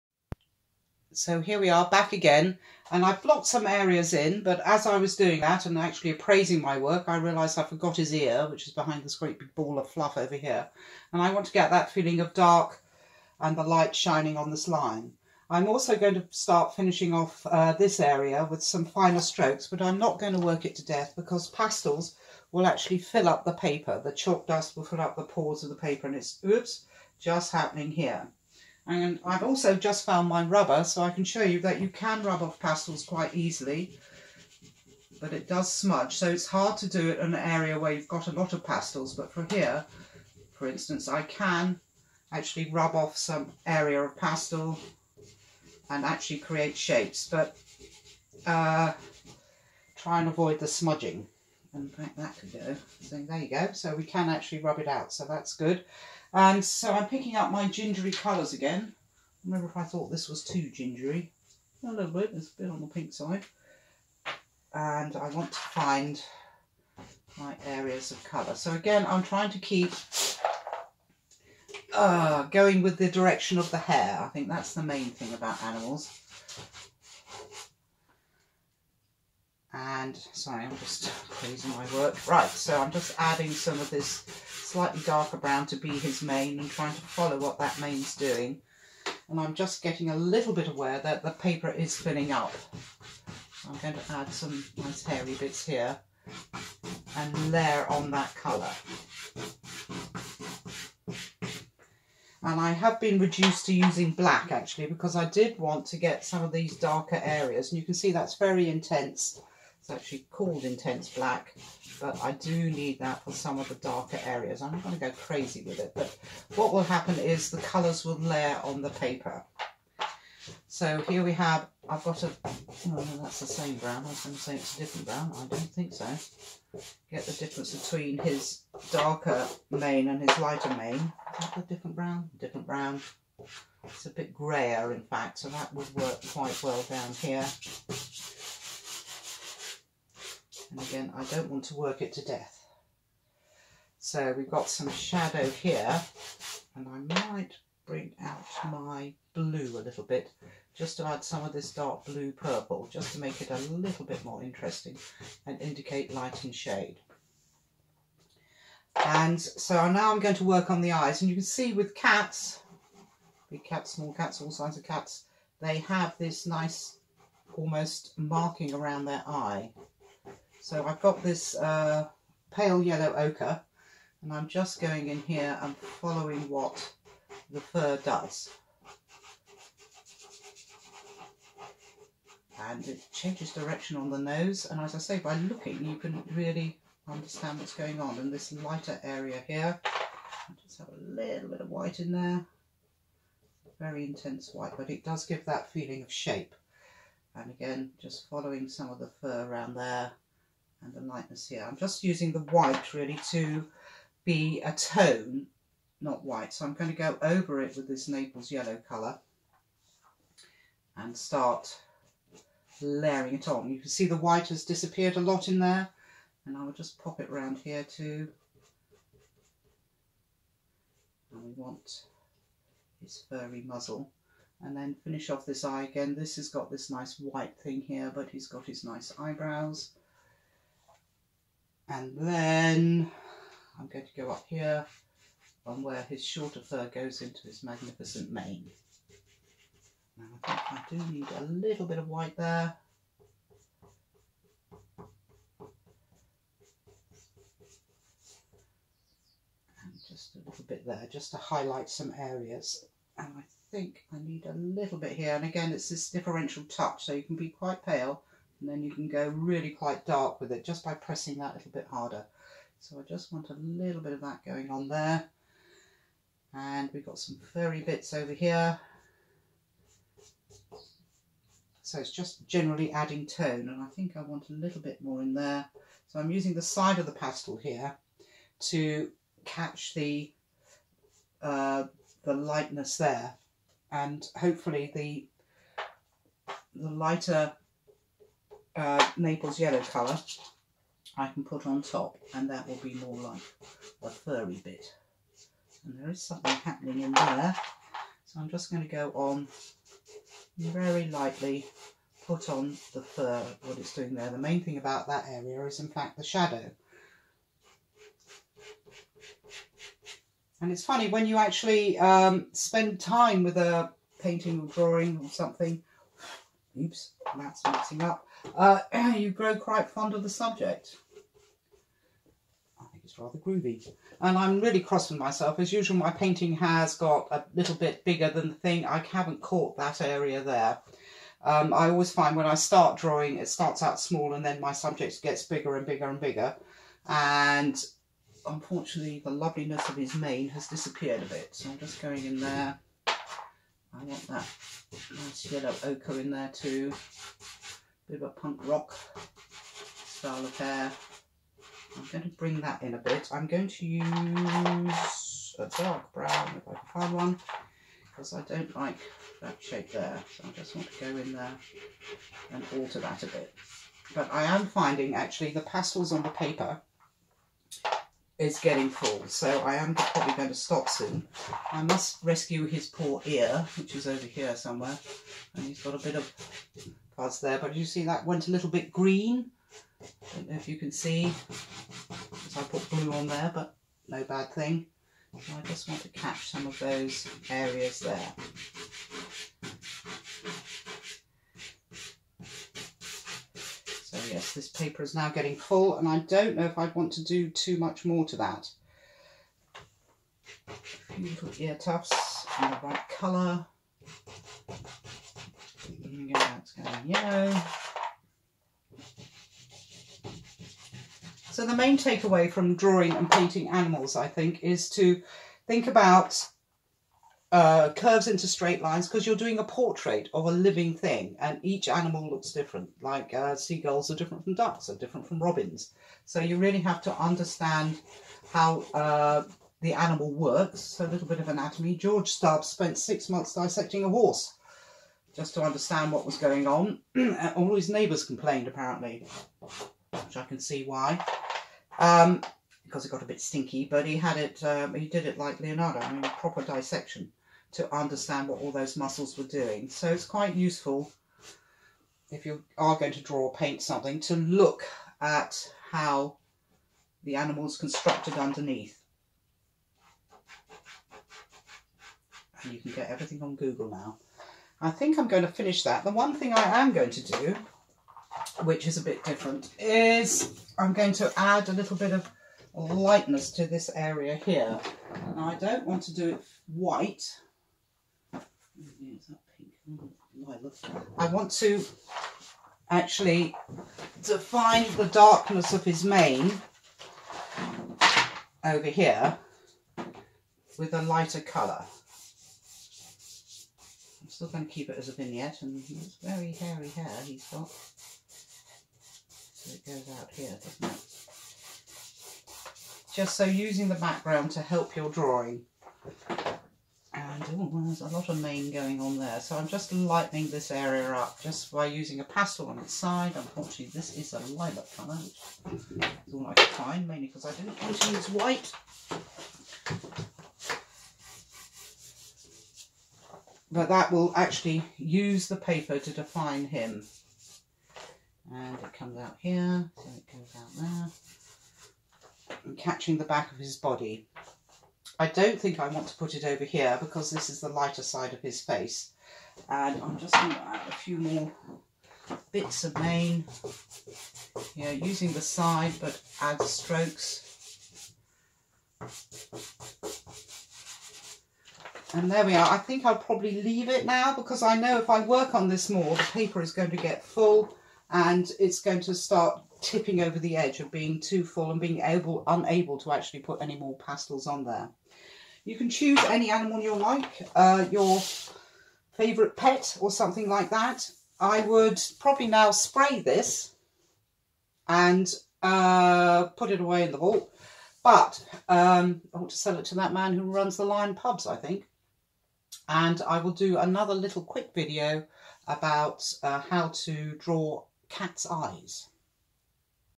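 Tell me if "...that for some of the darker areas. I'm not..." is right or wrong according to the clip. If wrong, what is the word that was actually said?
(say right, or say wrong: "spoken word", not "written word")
right.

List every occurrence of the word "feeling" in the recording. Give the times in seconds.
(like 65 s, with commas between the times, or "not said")
11 s, 195 s.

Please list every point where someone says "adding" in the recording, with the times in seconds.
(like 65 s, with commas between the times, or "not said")
83 s, 272 s.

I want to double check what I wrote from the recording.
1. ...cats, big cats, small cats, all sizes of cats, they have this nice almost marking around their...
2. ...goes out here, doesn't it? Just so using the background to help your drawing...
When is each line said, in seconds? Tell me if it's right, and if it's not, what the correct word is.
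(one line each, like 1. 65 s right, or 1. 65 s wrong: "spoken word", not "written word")
1. 161 s right
2. 499 s right.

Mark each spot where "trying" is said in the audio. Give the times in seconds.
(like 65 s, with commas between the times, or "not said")
69 s, 86 s.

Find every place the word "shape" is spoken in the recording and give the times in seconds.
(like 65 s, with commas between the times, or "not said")
46 s, 196 s, 359 s.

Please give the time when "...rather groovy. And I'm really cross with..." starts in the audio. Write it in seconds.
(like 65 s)
323 s.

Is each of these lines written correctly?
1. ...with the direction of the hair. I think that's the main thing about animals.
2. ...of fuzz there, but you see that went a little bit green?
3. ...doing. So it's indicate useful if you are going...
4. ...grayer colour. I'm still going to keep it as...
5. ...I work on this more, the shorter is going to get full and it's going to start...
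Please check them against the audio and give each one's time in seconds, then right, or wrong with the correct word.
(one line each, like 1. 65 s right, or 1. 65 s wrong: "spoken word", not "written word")
1. 72 s right
2. 376 s right
3. 449 s wrong: "quite", not "indicate"
4. 491 s wrong: "lighter", not "grayer"
5. 555 s wrong: "paper", not "shorter".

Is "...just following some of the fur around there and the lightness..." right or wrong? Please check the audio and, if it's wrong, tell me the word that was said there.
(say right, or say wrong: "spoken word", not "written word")
right.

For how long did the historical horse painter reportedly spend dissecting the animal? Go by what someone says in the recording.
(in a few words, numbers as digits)
6 months.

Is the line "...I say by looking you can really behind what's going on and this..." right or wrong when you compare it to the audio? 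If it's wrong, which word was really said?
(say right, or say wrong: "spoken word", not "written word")
wrong: "understand", not "behind".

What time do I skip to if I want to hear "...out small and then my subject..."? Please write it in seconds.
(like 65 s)
333 s.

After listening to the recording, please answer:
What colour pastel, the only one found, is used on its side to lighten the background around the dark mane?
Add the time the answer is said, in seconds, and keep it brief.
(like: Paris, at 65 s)
lilac, at 514 s.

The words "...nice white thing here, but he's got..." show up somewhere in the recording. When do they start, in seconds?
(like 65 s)
226 s.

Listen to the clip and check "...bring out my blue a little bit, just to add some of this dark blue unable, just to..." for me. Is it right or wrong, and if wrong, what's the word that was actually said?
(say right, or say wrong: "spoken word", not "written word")
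wrong: "purple", not "unable".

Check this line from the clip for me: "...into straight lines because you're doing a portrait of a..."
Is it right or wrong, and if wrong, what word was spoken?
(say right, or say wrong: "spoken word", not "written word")
right.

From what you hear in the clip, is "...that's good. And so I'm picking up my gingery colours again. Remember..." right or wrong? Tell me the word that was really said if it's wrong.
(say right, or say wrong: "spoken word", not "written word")
right.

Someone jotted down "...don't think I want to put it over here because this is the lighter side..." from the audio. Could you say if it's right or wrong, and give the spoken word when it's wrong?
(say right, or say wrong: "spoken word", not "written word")
right.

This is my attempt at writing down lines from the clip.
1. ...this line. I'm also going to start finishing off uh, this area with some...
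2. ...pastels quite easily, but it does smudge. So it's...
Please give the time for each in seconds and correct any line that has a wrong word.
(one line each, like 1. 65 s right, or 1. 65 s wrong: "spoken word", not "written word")
1. 14 s right
2. 32 s right.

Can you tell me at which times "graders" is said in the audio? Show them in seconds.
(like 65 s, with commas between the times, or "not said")
not said.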